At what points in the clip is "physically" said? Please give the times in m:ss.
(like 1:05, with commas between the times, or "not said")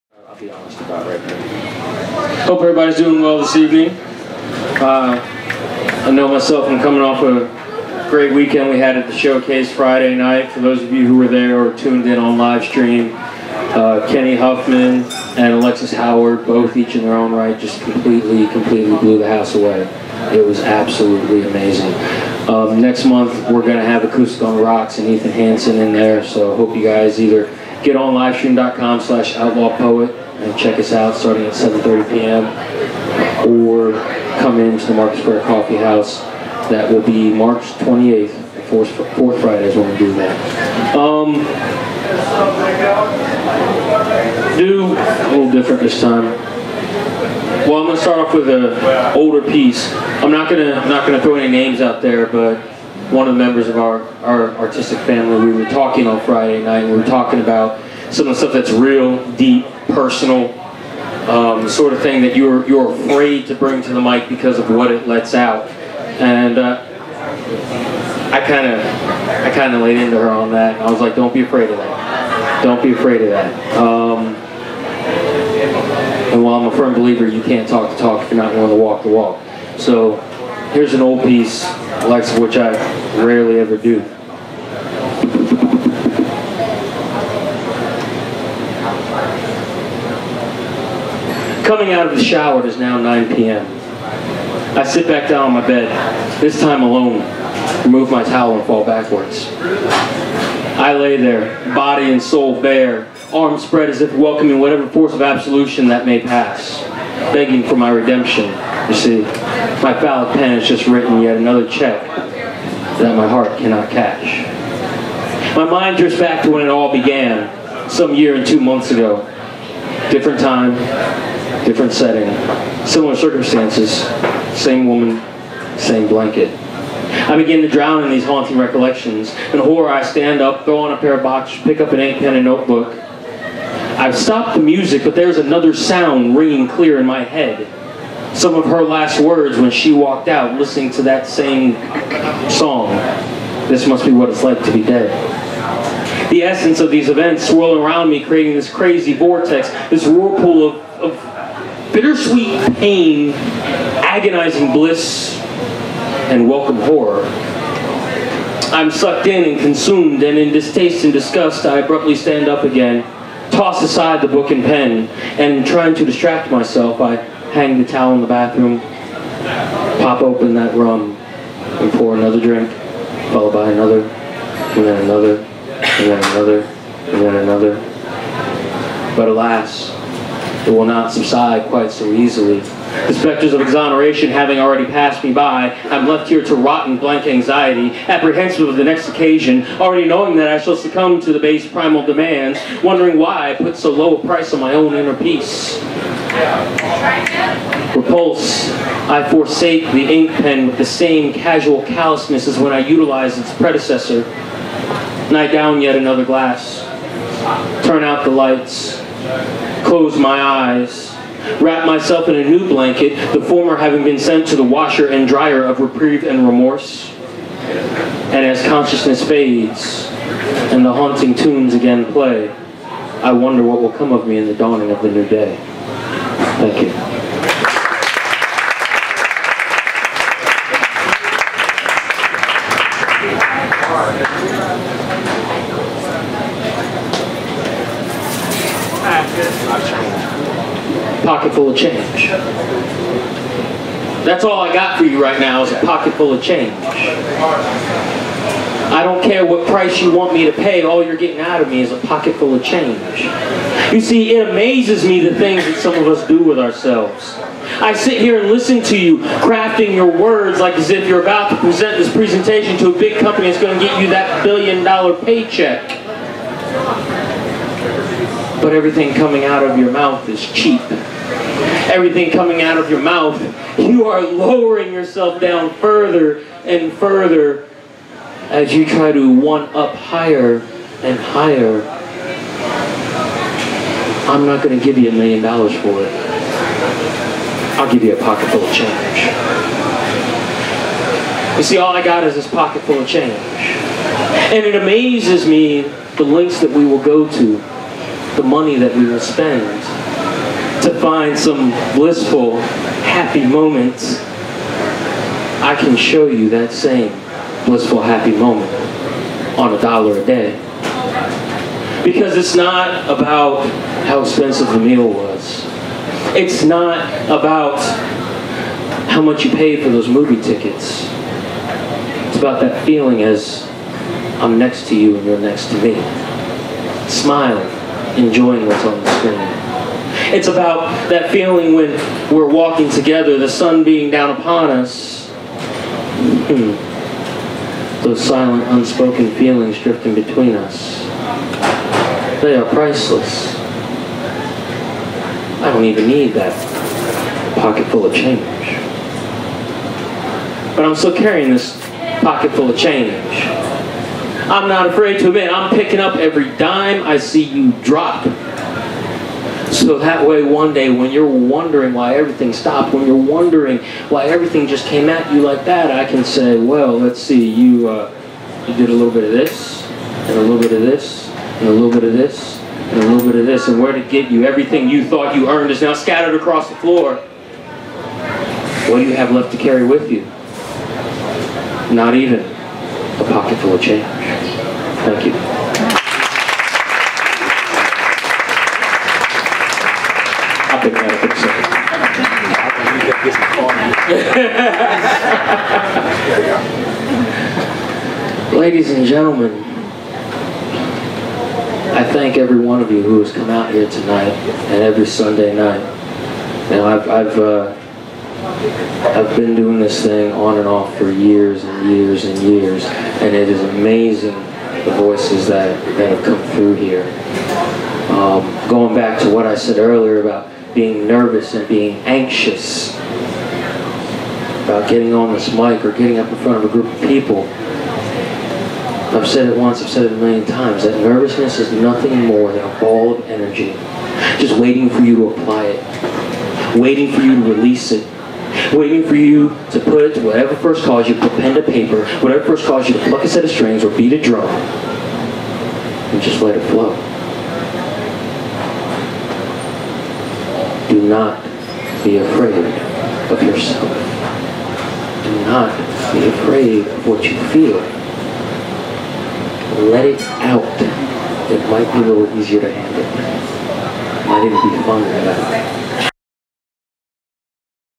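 not said.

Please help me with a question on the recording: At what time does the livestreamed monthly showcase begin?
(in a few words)
7:30 p.m.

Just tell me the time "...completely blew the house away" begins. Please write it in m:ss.
0:18.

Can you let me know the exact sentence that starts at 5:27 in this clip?
smiling enjoying what's on the screen.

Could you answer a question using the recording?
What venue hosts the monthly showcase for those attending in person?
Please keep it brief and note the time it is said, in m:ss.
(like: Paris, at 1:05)
Market Square Coffee House, at 0:34.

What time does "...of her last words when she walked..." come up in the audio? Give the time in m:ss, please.
2:18.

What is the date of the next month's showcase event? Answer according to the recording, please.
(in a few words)
March 28th.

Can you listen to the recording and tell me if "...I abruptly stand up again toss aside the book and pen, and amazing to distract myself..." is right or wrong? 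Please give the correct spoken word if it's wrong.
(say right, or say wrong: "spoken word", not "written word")
wrong: "trying", not "amazing".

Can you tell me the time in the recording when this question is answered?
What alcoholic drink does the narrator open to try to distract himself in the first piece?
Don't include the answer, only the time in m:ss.
2:50.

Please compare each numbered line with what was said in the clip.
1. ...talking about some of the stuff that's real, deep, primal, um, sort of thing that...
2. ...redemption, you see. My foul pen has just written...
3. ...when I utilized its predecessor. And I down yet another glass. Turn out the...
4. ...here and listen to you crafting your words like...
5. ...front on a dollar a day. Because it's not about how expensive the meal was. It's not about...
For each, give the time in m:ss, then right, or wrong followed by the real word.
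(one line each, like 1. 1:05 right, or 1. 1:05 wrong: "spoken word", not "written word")
1. 0:57 wrong: "personal", not "primal"
2. 1:47 right
3. 3:22 right
4. 4:18 right
5. 5:08 wrong: "moment", not "front".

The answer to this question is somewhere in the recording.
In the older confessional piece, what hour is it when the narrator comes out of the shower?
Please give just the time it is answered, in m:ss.
1:32.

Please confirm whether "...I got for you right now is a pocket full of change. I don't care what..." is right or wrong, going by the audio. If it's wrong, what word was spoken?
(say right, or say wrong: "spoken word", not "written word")
right.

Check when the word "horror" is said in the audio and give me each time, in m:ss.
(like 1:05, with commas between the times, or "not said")
2:09, 2:36.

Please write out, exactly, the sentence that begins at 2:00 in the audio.
Different time, different setting, similar circumstances, same woman, same blanket.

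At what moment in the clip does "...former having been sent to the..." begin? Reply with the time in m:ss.
3:33.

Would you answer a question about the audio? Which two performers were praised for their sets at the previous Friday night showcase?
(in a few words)
Kenny Huffman and Alexis Howard.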